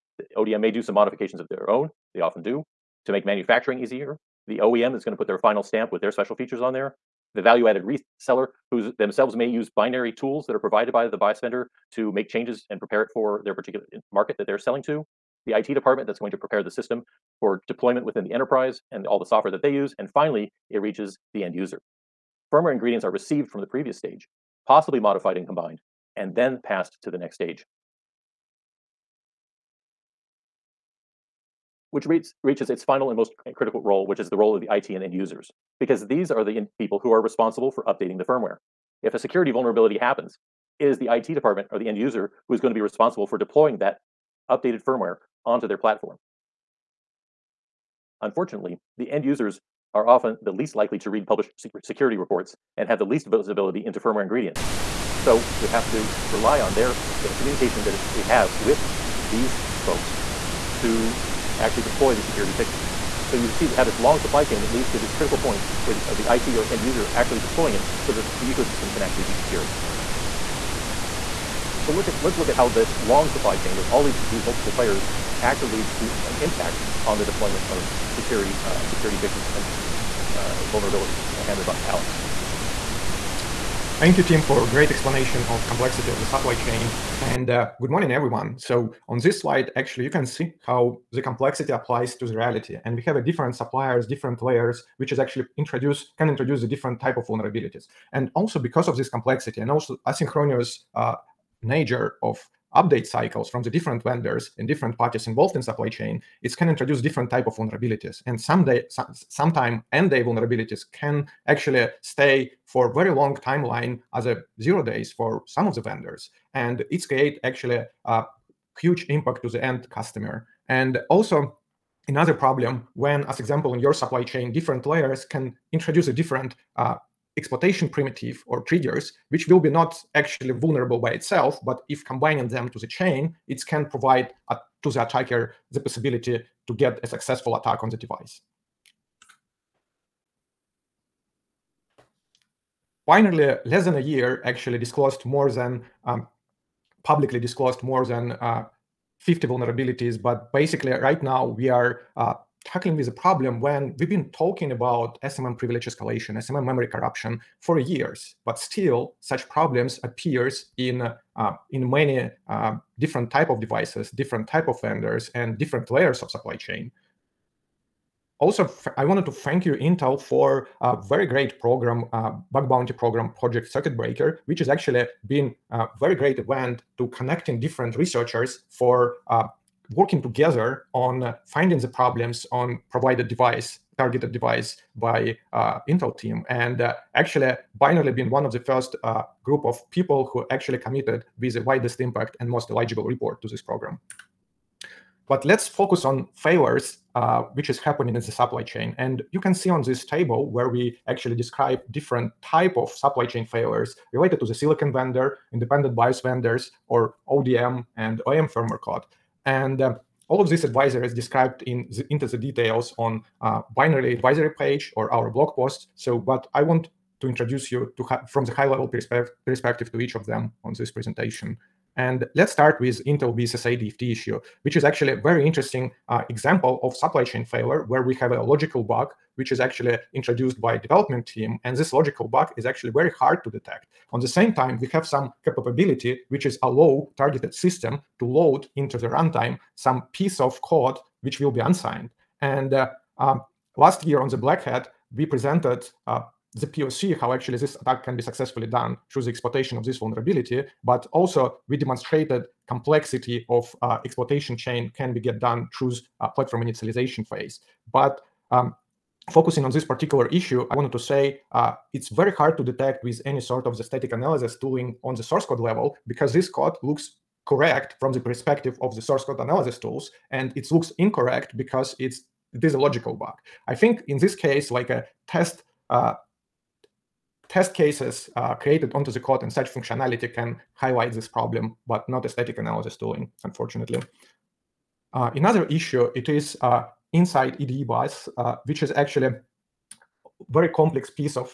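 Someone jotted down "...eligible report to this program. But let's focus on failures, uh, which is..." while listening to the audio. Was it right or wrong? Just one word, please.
right.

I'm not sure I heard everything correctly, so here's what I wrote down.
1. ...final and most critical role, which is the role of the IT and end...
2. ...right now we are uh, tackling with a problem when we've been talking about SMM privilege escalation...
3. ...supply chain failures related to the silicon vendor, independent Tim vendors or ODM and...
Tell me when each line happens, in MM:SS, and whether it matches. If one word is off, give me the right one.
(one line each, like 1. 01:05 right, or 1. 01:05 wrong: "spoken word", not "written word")
1. 00:32 right
2. 02:30 right
3. 03:22 wrong: "BIOS", not "Tim".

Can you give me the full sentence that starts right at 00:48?
Unfortunately, the end users are often the least likely to read published security reports and have the least visibility into firmware ingredients.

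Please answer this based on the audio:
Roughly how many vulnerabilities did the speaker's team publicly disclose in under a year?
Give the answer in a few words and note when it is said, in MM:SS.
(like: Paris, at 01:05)
more than 50, at 02:27.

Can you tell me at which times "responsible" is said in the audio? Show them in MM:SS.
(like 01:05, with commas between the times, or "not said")
00:37, 00:42.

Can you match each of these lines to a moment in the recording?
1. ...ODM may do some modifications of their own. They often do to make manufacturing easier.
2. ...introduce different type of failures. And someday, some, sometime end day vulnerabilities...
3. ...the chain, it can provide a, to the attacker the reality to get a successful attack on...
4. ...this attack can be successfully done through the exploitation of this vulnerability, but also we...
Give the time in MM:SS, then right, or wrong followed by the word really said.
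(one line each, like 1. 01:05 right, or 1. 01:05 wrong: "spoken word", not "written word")
1. 00:00 right
2. 01:46 wrong: "vulnerabilities", not "failures"
3. 02:12 wrong: "possibility", not "reality"
4. 04:07 right.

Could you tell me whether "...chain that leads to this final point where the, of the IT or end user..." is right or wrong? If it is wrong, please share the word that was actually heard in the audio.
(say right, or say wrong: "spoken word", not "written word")
wrong: "critical", not "final".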